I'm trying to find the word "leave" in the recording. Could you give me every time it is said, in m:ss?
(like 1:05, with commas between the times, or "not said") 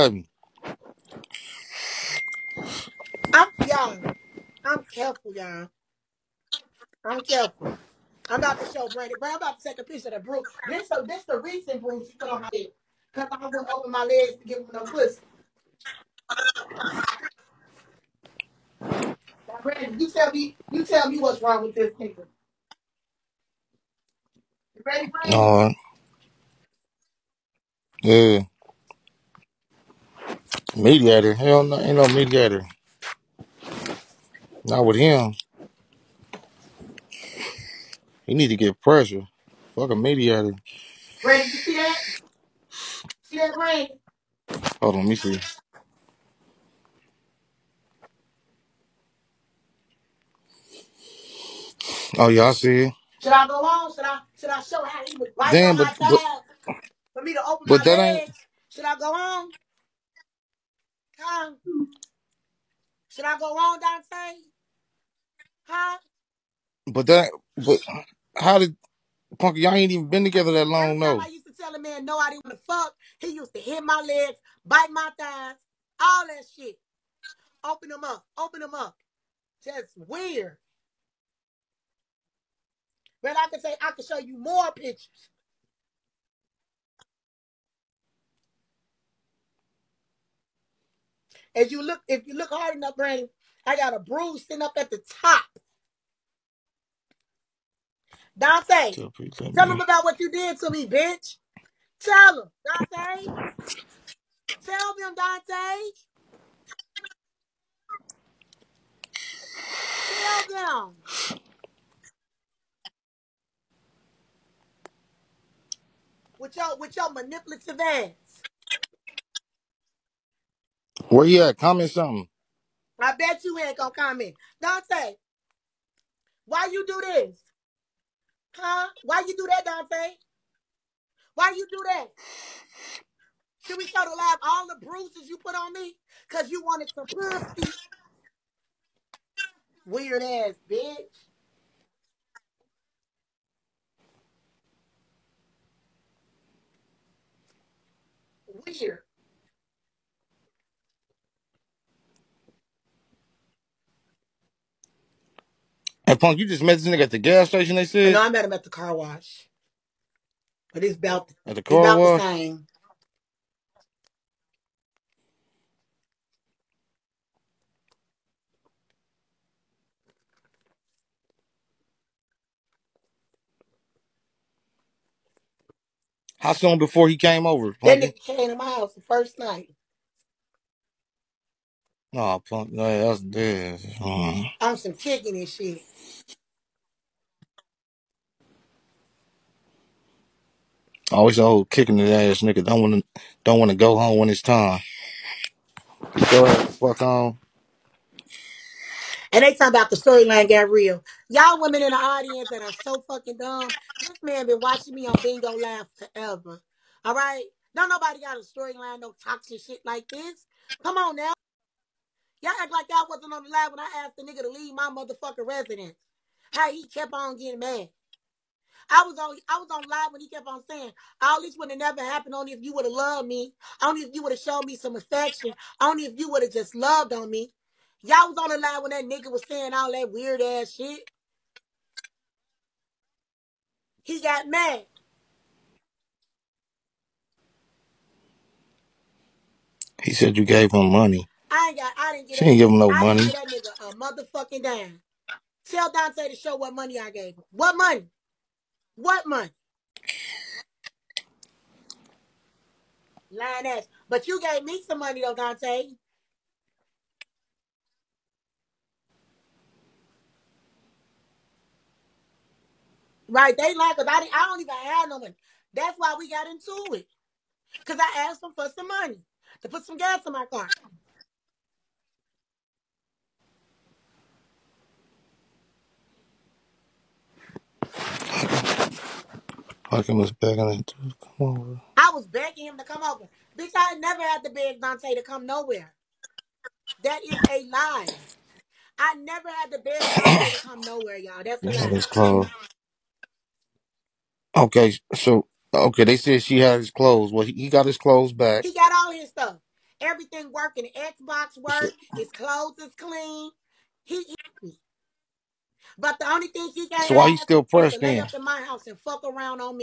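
3:34.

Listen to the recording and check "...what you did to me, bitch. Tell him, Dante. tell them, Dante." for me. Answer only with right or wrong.
right.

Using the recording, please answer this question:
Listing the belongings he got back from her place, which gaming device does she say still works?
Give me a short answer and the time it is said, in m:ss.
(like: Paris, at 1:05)
Xbox, at 5:00.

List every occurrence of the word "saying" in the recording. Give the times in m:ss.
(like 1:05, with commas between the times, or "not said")
3:40, 3:49.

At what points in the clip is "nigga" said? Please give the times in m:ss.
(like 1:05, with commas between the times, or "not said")
0:21, 2:36, 2:58, 3:12, 3:34, 3:49, 4:03.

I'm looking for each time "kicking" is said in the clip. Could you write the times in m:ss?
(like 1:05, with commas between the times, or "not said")
3:04, 3:11.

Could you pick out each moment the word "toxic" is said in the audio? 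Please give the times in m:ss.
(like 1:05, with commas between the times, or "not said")
3:29.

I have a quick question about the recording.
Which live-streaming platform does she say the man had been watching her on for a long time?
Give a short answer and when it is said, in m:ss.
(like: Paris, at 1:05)
Bigo Live, at 3:25.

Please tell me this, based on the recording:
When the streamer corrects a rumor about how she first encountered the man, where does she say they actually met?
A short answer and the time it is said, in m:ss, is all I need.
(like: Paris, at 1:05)
car wash, at 2:38.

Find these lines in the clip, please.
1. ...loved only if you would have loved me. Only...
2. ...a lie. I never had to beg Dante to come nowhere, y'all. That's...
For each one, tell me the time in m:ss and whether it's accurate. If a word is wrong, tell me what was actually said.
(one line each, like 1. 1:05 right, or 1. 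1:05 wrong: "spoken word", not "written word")
1. 3:42 wrong: "happened", not "loved"
2. 4:47 right.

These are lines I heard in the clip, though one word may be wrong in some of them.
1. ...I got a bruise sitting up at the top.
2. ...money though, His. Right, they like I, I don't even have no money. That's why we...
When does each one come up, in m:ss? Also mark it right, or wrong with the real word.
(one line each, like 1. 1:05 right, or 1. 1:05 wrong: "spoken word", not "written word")
1. 1:33 right
2. 4:14 wrong: "Dante", not "His".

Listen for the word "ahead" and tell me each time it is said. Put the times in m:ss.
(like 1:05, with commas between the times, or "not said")
3:16.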